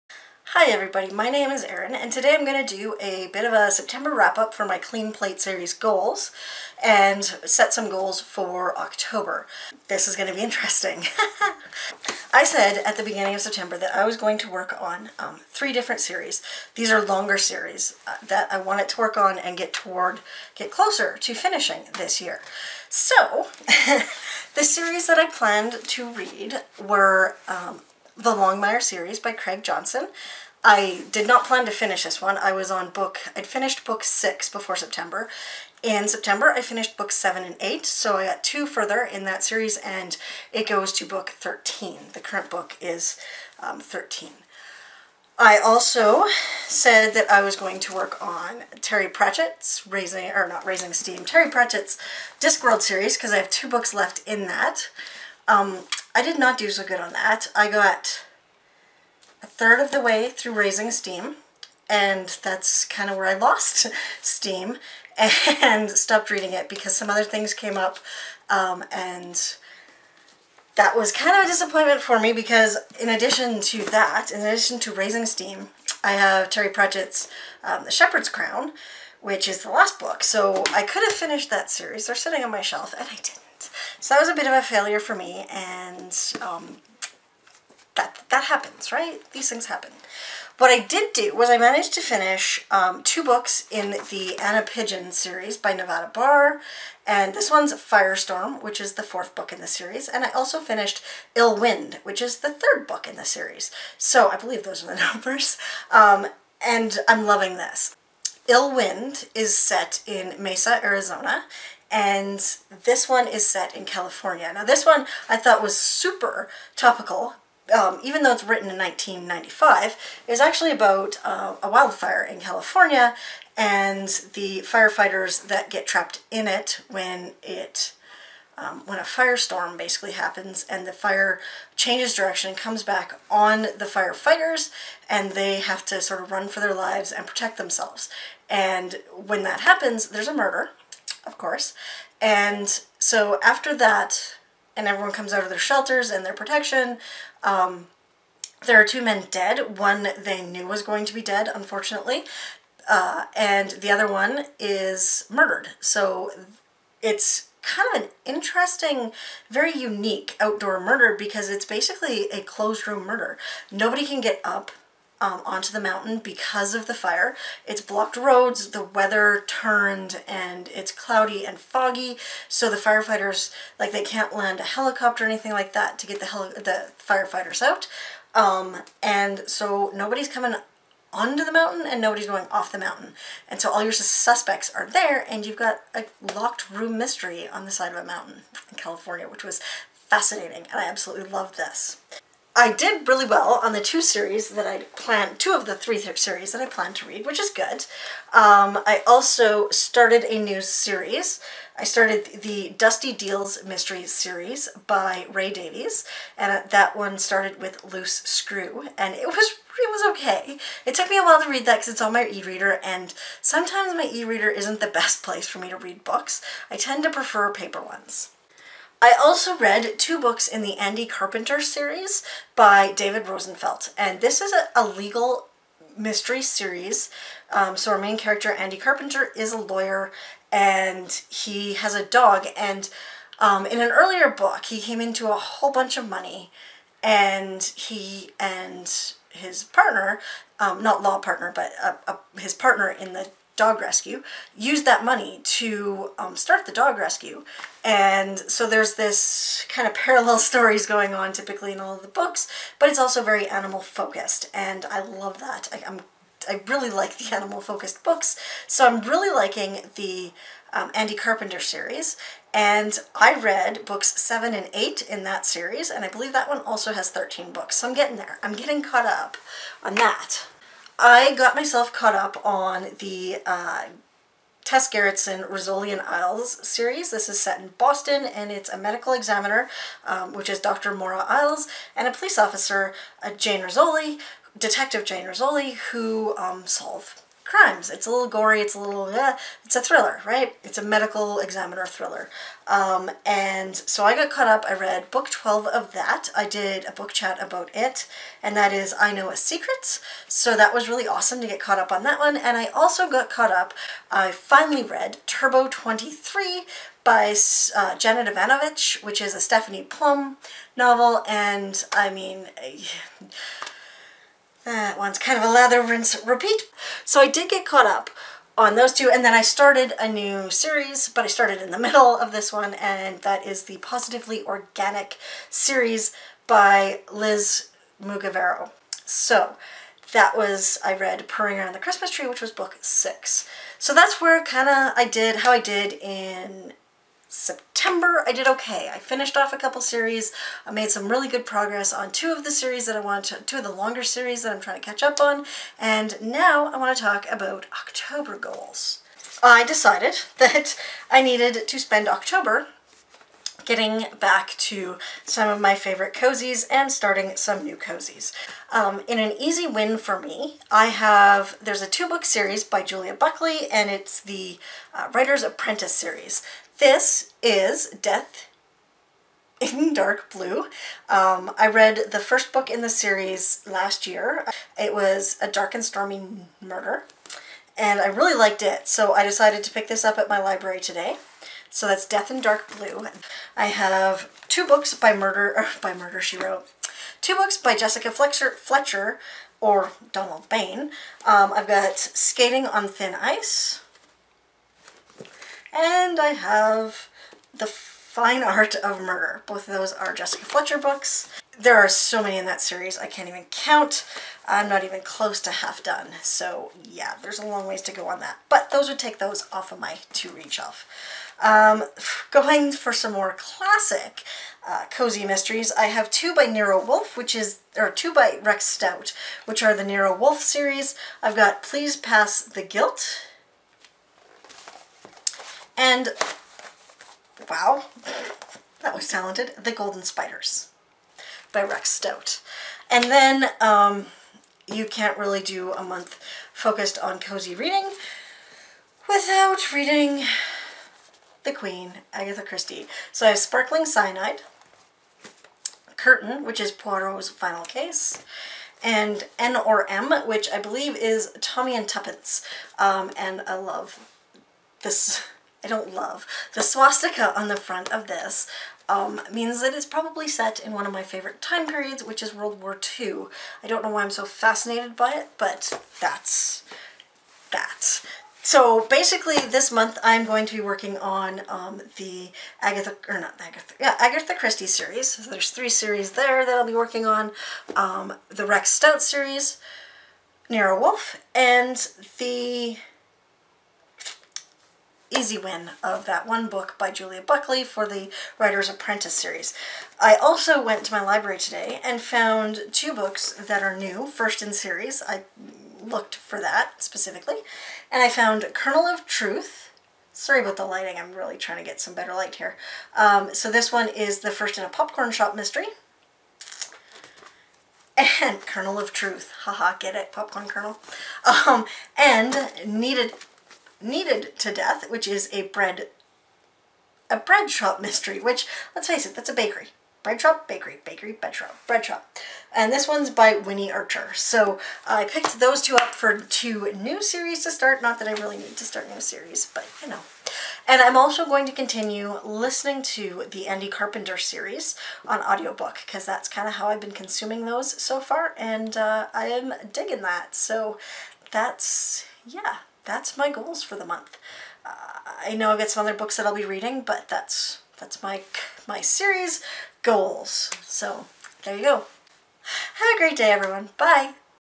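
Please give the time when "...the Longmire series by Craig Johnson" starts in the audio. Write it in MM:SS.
00:28.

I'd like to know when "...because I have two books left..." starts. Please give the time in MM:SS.
00:53.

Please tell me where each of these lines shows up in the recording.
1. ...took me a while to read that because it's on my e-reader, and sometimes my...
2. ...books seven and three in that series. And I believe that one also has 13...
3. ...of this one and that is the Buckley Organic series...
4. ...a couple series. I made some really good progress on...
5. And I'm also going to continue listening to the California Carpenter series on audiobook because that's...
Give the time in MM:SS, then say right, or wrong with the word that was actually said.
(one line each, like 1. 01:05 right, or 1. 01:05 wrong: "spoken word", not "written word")
1. 03:30 right
2. 04:23 wrong: "eight", not "three"
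3. 05:22 wrong: "Positively", not "Buckley"
4. 05:39 right
5. 08:50 wrong: "Andy", not "California".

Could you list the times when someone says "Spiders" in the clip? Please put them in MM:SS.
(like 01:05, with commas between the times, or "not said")
07:10.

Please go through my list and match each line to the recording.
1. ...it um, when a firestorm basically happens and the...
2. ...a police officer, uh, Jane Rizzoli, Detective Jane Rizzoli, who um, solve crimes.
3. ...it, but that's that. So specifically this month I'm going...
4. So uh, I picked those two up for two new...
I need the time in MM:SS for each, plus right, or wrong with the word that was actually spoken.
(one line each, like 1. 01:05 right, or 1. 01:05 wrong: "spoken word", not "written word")
1. 02:07 right
2. 04:42 right
3. 07:45 wrong: "basically", not "specifically"
4. 08:44 right.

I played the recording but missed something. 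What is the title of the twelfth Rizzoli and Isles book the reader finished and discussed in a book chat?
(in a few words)
I Know a Secret.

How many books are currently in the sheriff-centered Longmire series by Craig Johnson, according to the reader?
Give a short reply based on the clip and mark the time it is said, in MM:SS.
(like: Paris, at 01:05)
13, at 00:40.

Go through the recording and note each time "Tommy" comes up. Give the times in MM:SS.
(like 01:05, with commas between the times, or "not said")
07:31.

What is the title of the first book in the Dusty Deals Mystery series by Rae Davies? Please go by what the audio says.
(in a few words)
Loose Screw.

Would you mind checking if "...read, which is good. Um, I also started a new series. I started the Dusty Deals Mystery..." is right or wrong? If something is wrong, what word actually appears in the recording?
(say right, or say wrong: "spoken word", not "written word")
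right.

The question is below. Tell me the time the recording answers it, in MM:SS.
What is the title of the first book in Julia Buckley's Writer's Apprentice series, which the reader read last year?
06:15.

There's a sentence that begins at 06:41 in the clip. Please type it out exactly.
There are so many in that series, I can't even count.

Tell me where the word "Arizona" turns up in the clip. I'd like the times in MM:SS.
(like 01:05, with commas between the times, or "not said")
01:50.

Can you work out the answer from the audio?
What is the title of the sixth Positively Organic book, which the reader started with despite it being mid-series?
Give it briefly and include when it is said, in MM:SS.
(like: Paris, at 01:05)
Purring Around the Christmas Tree, at 05:31.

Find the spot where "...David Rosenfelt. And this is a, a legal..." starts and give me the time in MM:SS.
03:42.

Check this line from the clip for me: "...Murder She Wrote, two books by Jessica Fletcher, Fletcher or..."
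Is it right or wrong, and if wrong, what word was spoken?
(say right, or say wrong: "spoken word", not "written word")
right.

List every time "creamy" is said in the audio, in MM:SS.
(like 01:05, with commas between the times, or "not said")
not said.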